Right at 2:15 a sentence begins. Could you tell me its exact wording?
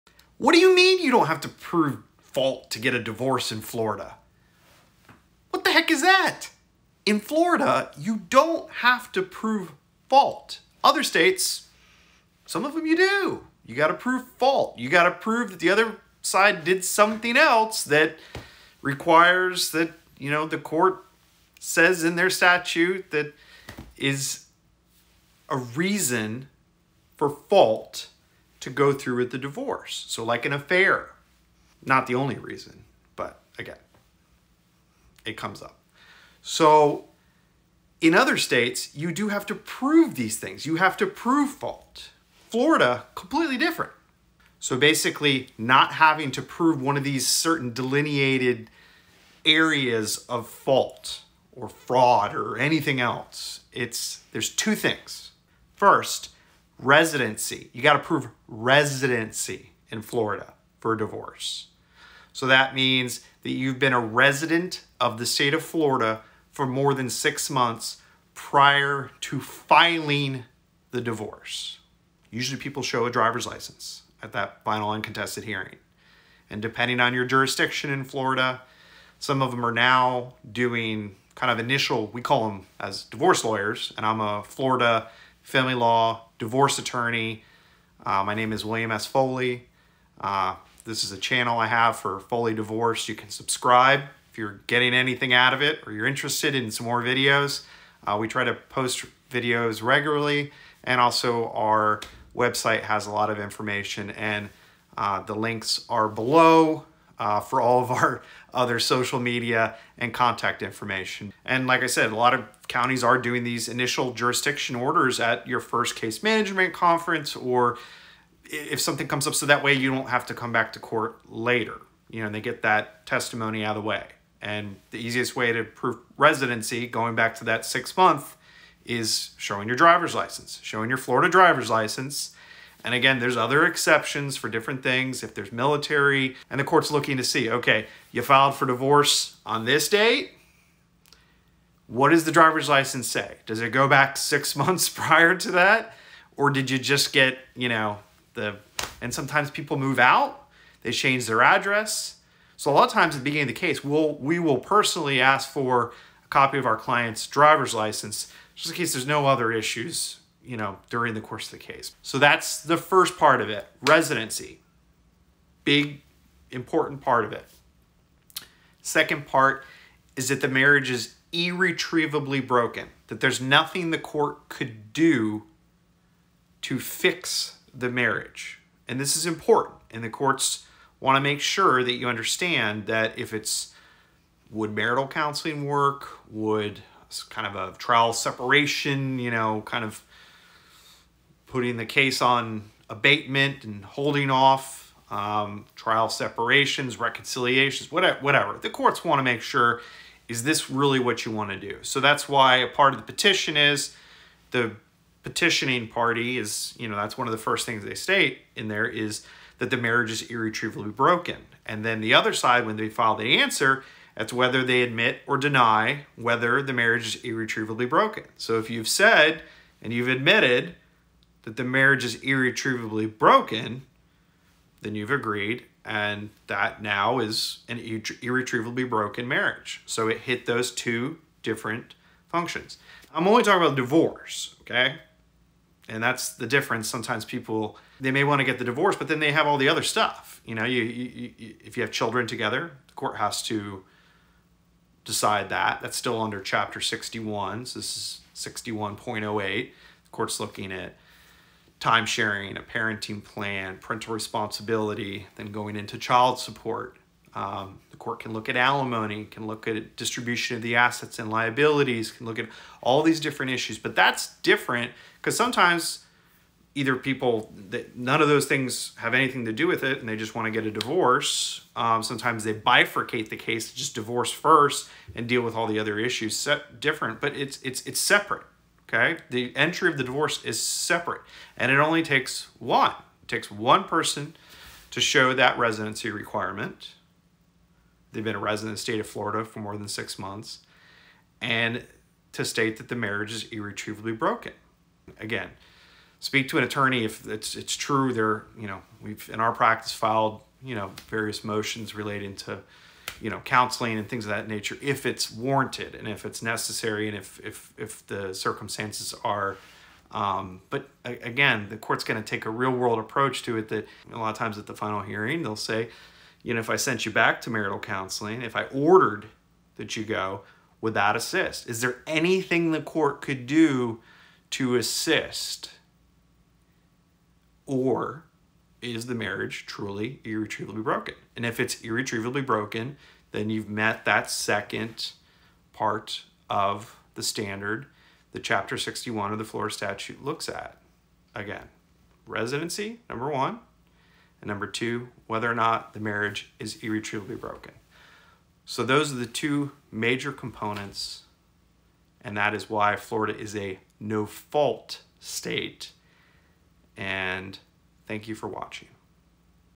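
If there's military and the court's looking to see, okay, you filed for divorce on this date.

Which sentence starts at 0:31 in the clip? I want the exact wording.
Not the only reason, but again, it comes up.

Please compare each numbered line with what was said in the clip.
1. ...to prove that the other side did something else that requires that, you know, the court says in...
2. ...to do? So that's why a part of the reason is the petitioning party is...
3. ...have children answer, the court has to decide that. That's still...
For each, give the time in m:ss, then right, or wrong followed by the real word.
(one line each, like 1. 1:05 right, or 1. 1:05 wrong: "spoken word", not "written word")
1. 0:15 right
2. 3:21 wrong: "petition", not "reason"
3. 4:01 wrong: "together", not "answer".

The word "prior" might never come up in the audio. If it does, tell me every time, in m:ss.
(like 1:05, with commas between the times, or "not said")
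1:08, 2:24.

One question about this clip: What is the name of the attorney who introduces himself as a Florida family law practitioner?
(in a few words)
William S. Foley.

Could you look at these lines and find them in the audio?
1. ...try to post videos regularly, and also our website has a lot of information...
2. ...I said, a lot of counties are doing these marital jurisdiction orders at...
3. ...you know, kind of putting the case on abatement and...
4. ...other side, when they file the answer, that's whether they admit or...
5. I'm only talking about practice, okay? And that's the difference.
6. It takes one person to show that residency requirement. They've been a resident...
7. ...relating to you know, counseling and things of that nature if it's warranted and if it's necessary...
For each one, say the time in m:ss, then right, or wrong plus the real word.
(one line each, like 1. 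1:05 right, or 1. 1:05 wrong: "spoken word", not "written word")
1. 1:38 right
2. 1:51 wrong: "initial", not "marital"
3. 3:09 right
4. 3:32 right
5. 3:53 wrong: "divorce", not "practice"
6. 4:43 right
7. 5:01 right.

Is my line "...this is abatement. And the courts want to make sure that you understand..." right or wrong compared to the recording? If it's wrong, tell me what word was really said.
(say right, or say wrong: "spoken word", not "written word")
wrong: "important", not "abatement".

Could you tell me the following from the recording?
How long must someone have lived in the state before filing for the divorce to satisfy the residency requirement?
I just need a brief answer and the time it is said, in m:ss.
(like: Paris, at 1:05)
6 months, at 1:07.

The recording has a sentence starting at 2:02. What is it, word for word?
You know, they get that testimony out of the way.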